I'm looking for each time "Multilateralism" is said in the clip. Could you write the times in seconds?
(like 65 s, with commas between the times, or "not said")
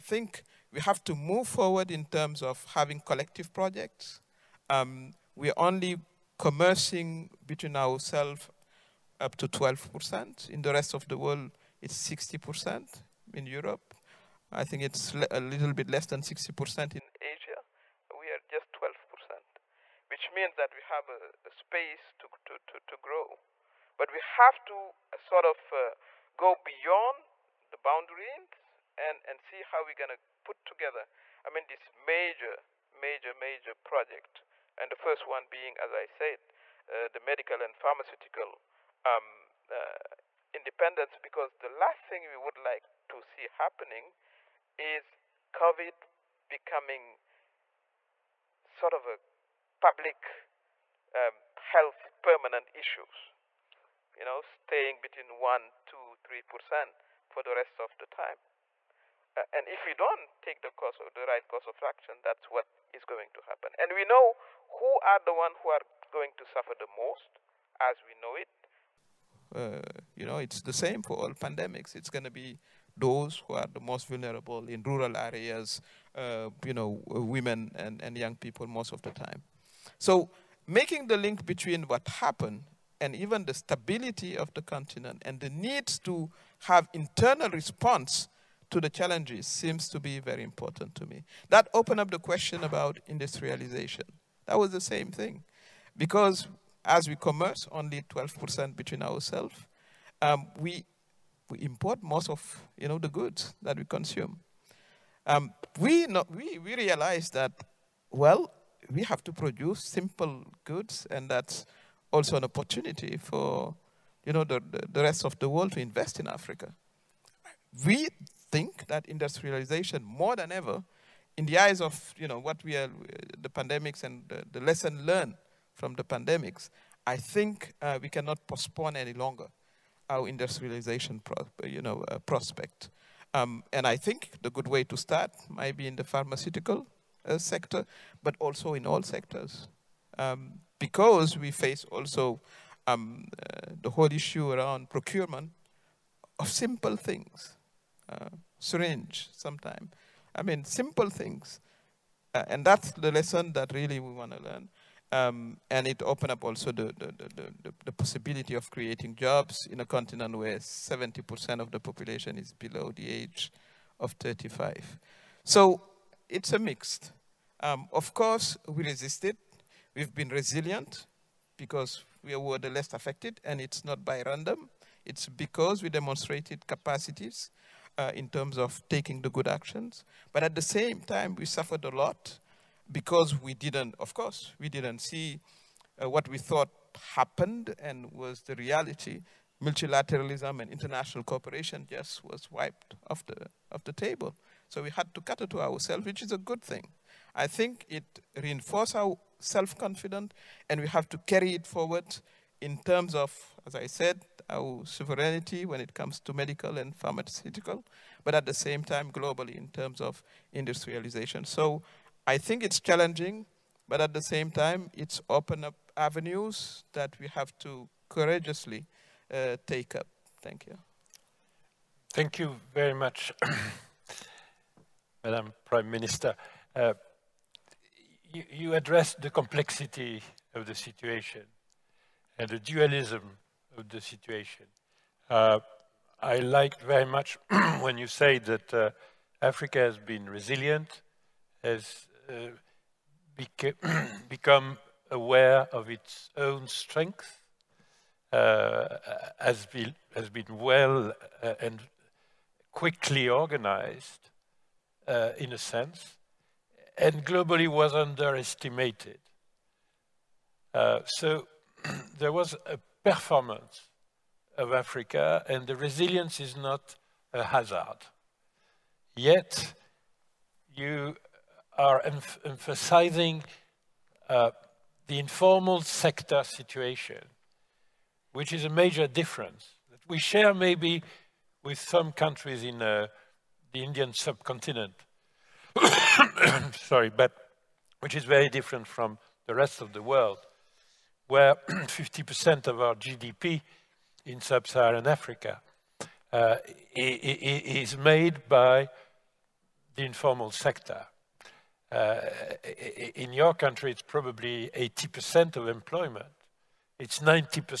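189 s.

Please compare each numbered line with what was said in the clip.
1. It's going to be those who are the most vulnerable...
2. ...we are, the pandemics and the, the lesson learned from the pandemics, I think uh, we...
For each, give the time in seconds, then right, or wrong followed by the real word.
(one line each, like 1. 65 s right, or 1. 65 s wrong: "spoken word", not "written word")
1. 71 s right
2. 122 s right.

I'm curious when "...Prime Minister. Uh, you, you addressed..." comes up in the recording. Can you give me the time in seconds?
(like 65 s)
225 s.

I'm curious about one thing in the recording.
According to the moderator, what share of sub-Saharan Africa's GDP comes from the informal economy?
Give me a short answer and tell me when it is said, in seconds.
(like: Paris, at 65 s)
50%, at 291 s.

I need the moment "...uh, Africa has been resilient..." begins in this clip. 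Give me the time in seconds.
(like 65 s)
238 s.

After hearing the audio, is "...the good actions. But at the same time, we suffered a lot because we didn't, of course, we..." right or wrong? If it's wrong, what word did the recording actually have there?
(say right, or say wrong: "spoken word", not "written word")
right.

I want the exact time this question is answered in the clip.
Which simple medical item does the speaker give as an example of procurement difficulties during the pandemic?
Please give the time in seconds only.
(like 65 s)
148 s.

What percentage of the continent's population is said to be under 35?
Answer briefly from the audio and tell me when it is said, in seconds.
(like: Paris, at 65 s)
70%, at 160 s.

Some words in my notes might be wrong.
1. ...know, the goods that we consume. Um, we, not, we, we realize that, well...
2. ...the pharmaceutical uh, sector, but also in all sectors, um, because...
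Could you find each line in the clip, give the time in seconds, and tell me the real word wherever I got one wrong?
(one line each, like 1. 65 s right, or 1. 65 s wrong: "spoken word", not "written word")
1. 102 s right
2. 135 s right.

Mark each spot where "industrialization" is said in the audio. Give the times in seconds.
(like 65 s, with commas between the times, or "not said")
93 s, 119 s, 130 s, 210 s.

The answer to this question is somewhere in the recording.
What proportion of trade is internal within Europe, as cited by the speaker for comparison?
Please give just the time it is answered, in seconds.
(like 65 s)
12 s.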